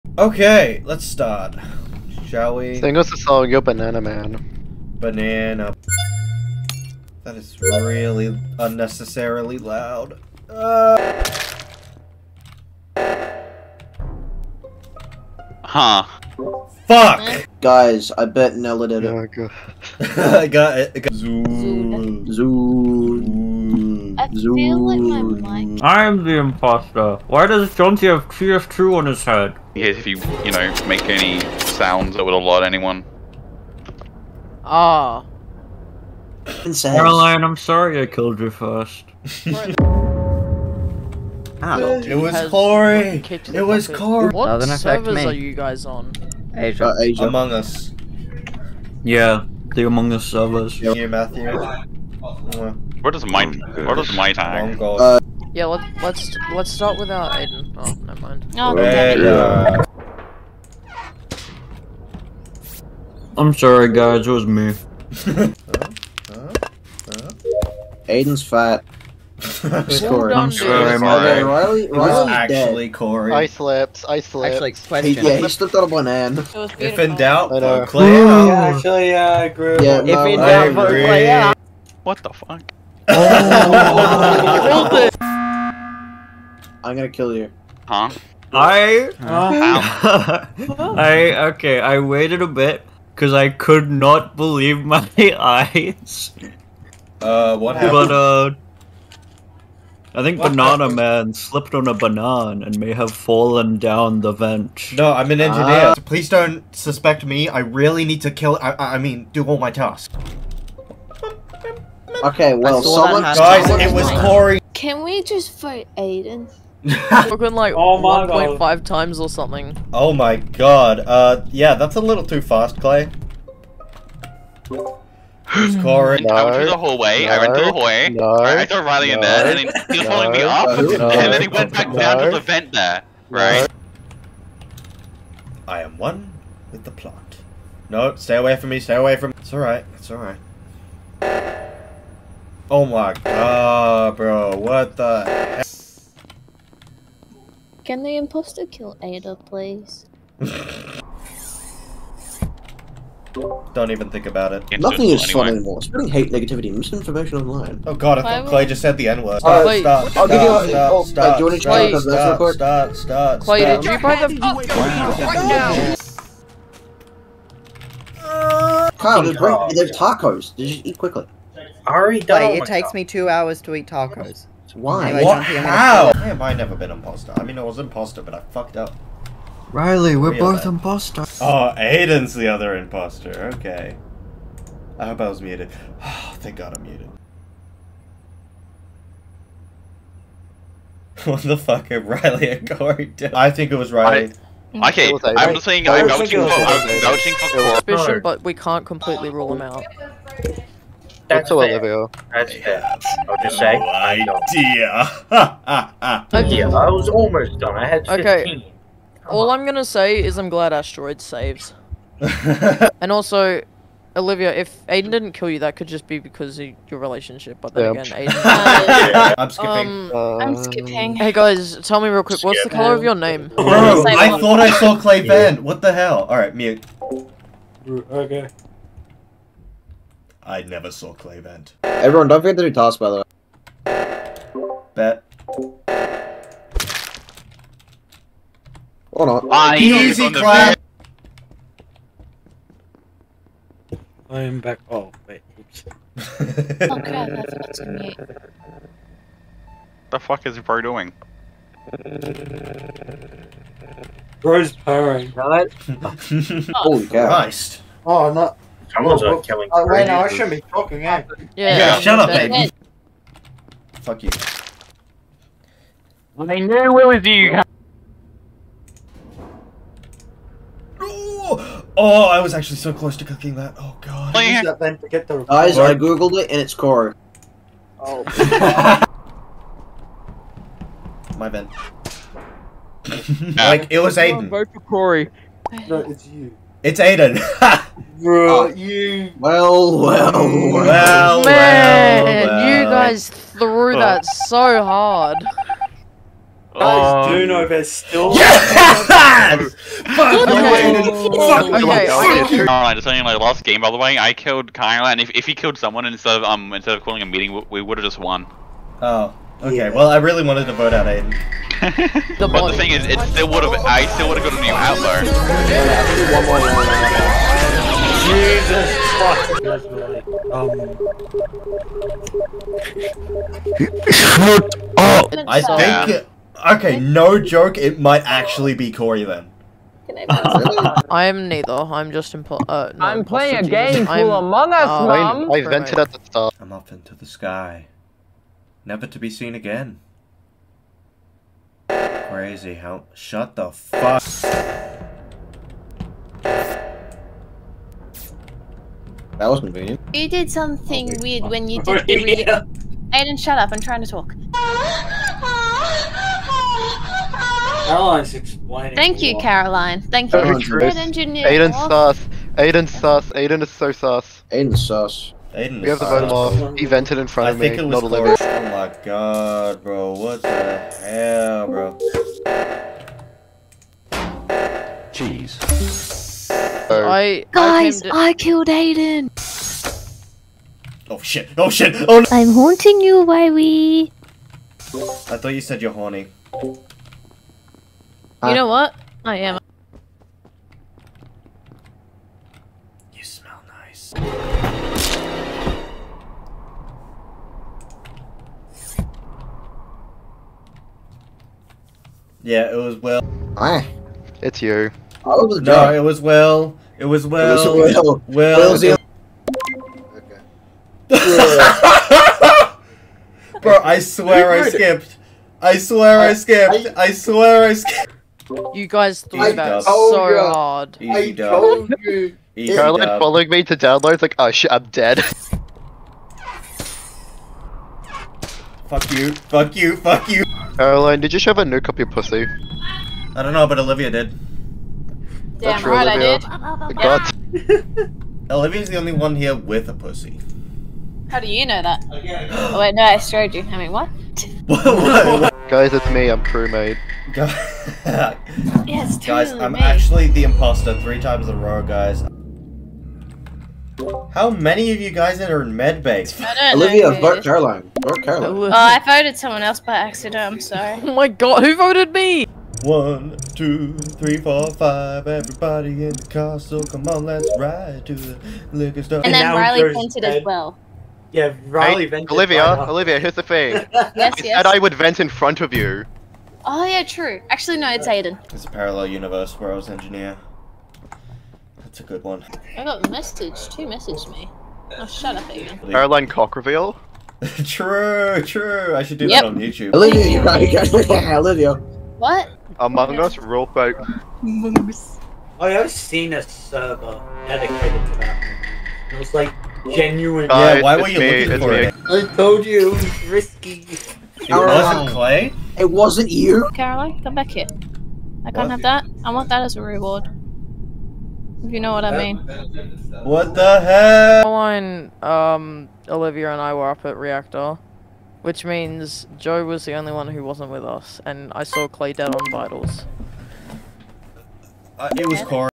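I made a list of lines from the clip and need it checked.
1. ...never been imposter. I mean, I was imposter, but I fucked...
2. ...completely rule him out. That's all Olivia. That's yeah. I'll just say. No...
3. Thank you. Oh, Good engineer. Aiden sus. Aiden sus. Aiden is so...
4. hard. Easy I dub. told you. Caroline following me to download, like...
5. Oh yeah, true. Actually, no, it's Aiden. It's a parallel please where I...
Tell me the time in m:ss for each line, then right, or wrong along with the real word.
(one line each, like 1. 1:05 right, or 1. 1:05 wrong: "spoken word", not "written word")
1. 2:56 right
2. 3:18 right
3. 6:00 right
4. 7:00 right
5. 7:56 wrong: "universe", not "please".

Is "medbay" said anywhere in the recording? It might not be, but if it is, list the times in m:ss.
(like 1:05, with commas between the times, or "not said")
7:35.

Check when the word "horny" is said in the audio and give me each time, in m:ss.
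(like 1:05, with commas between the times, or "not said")
6:25.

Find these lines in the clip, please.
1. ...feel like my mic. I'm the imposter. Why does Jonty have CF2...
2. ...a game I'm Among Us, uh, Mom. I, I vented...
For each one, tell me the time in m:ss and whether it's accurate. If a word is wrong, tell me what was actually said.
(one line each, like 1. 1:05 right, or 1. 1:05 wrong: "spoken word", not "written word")
1. 0:24 right
2. 5:33 right.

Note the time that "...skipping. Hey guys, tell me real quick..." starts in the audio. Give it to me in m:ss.
3:40.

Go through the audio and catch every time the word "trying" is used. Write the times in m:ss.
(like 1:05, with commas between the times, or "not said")
5:53.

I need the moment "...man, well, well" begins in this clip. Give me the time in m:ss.
4:51.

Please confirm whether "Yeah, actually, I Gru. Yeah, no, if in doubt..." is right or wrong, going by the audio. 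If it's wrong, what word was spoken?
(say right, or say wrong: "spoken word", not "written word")
right.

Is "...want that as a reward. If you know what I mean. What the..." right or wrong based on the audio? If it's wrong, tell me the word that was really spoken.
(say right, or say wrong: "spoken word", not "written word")
right.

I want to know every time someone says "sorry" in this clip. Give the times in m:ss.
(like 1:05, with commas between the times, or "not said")
0:37, 1:03, 7:40.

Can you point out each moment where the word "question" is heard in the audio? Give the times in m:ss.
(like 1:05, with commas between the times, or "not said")
1:14.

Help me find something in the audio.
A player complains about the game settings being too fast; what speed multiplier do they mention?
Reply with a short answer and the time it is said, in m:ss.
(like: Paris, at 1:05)
1.5 times, at 1:58.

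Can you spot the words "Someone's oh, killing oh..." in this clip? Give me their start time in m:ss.
4:18.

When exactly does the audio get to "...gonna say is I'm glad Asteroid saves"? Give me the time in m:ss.
3:29.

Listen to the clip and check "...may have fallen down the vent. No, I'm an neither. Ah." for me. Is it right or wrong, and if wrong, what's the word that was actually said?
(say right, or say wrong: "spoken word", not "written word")
wrong: "engineer", not "neither".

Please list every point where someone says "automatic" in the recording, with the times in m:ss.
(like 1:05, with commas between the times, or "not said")
not said.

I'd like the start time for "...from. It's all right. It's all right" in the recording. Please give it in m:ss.
2:19.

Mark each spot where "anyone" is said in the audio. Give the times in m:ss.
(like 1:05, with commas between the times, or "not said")
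0:32.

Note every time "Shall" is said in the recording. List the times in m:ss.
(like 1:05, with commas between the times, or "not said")
0:02.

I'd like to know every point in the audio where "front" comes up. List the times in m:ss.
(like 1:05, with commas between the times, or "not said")
6:07, 7:55.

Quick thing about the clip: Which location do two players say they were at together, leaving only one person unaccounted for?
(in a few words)
Reactor.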